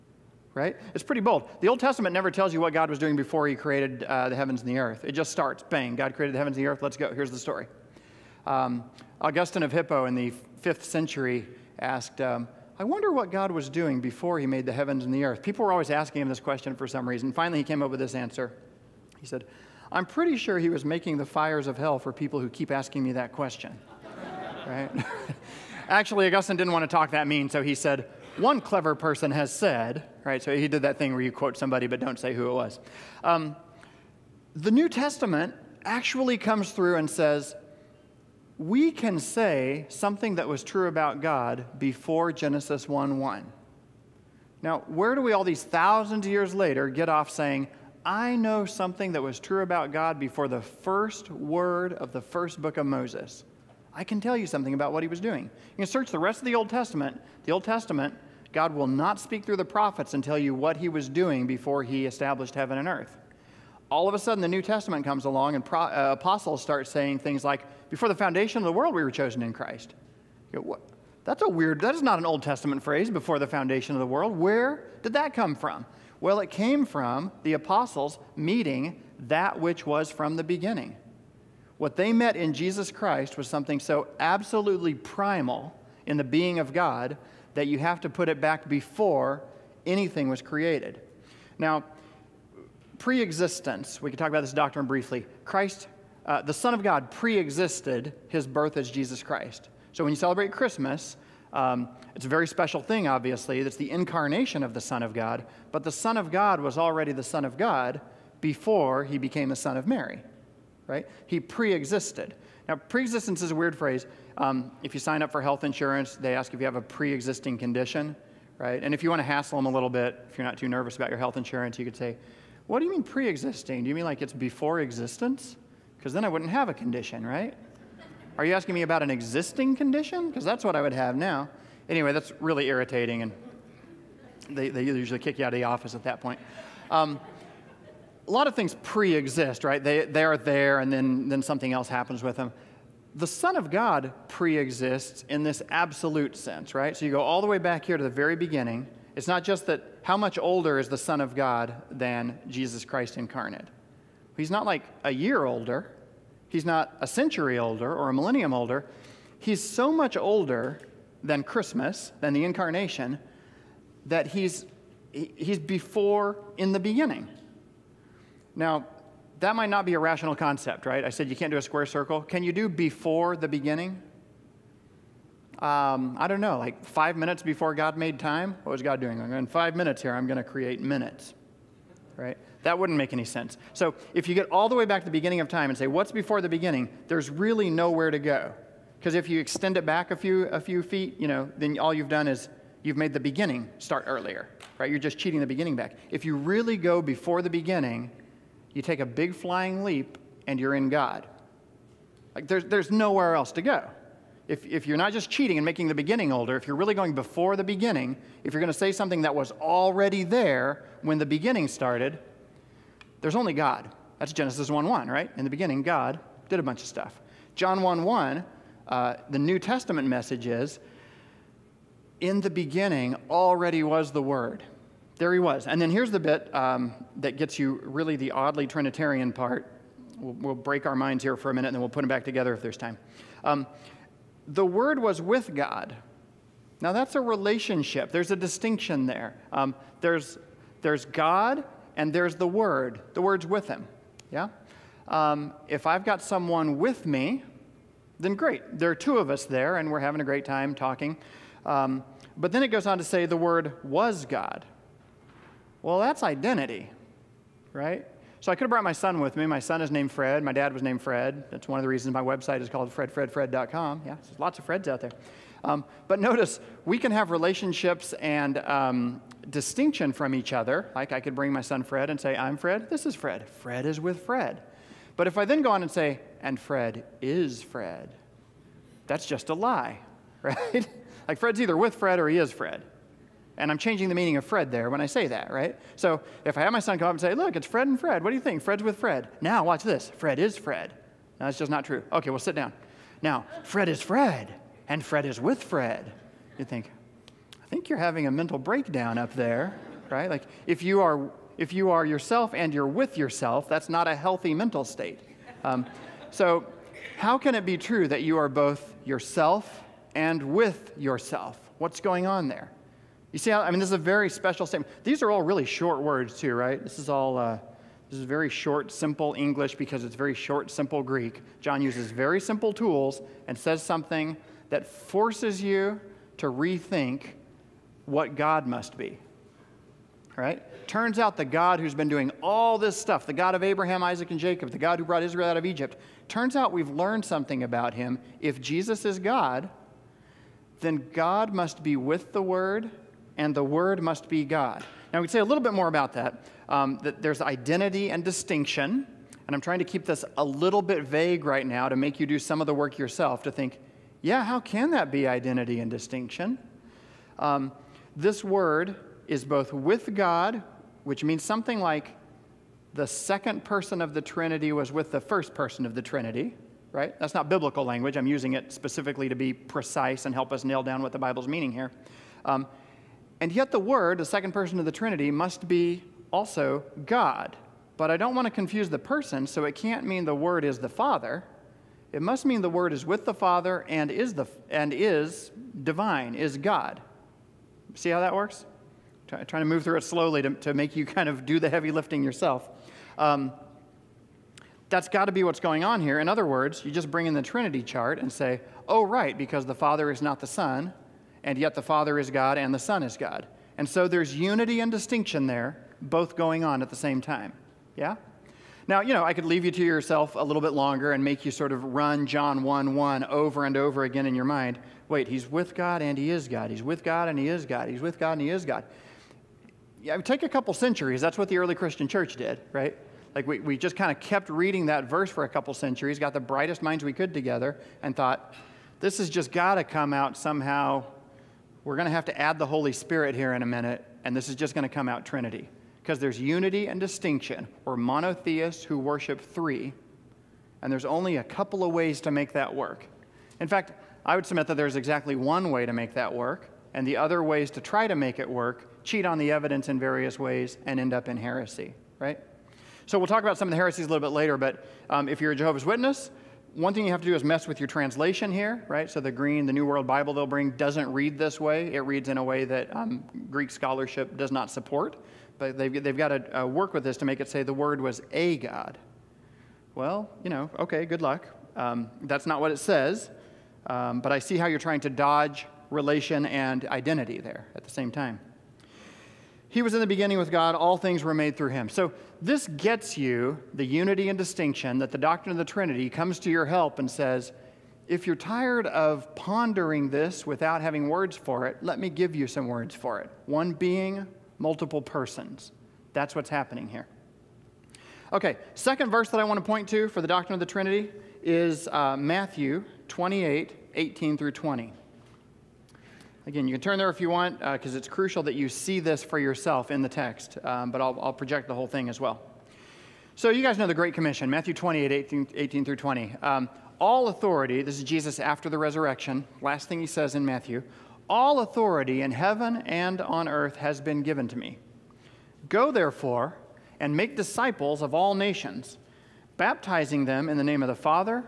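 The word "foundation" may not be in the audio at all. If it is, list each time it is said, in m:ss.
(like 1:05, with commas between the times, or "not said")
1:08, 1:13.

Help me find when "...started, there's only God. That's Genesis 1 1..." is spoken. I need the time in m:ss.
3:31.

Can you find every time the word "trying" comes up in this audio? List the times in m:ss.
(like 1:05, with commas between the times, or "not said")
5:49, 6:29, 7:54.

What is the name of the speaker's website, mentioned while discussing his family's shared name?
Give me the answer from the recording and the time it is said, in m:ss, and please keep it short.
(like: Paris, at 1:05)
fredfredfred.com, at 4:22.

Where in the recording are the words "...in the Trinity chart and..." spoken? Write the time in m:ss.
6:37.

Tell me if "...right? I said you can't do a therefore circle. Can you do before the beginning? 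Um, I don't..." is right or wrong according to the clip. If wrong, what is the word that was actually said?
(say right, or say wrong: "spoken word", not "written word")
wrong: "square", not "therefore".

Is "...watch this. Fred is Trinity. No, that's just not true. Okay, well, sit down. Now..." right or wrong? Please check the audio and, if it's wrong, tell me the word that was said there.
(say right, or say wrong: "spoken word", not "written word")
wrong: "Fred", not "Trinity".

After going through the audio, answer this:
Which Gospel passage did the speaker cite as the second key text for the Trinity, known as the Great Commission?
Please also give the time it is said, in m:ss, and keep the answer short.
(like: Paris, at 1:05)
Matthew 28:18-20, at 8:22.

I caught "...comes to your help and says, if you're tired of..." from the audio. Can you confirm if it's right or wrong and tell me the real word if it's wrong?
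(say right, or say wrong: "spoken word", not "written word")
right.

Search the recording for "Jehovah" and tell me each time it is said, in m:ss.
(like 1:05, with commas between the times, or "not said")
7:35.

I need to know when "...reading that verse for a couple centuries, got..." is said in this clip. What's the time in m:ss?
7:04.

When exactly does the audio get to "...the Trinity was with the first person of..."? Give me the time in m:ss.
6:04.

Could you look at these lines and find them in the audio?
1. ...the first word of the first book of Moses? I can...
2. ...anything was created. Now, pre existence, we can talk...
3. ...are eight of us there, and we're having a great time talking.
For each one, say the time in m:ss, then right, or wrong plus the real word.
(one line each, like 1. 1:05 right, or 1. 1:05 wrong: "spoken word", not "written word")
1. 0:50 right
2. 1:29 right
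3. 4:08 wrong: "two", not "eight".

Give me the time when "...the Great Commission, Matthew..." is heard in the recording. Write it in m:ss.
8:33.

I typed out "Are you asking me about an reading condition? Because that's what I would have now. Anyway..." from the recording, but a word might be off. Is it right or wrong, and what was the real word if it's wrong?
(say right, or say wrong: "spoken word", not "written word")
wrong: "existing", not "reading".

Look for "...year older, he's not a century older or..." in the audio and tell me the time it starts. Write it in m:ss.
2:35.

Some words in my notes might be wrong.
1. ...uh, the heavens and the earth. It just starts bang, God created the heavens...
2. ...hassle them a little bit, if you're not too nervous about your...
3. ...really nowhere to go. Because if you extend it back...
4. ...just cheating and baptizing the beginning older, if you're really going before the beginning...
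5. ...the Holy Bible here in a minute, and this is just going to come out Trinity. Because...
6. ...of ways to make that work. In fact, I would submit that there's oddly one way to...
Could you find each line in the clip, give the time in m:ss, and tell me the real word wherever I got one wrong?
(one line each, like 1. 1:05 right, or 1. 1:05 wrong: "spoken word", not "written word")
1. 0:04 right
2. 1:59 right
3. 3:07 right
4. 3:25 wrong: "making", not "baptizing"
5. 7:12 wrong: "Spirit", not "Bible"
6. 7:21 wrong: "exactly", not "oddly".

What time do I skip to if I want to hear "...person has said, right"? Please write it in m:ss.
0:28.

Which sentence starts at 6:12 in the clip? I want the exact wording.
Um, and yet the Word, the second person of the Trinity, must be also God.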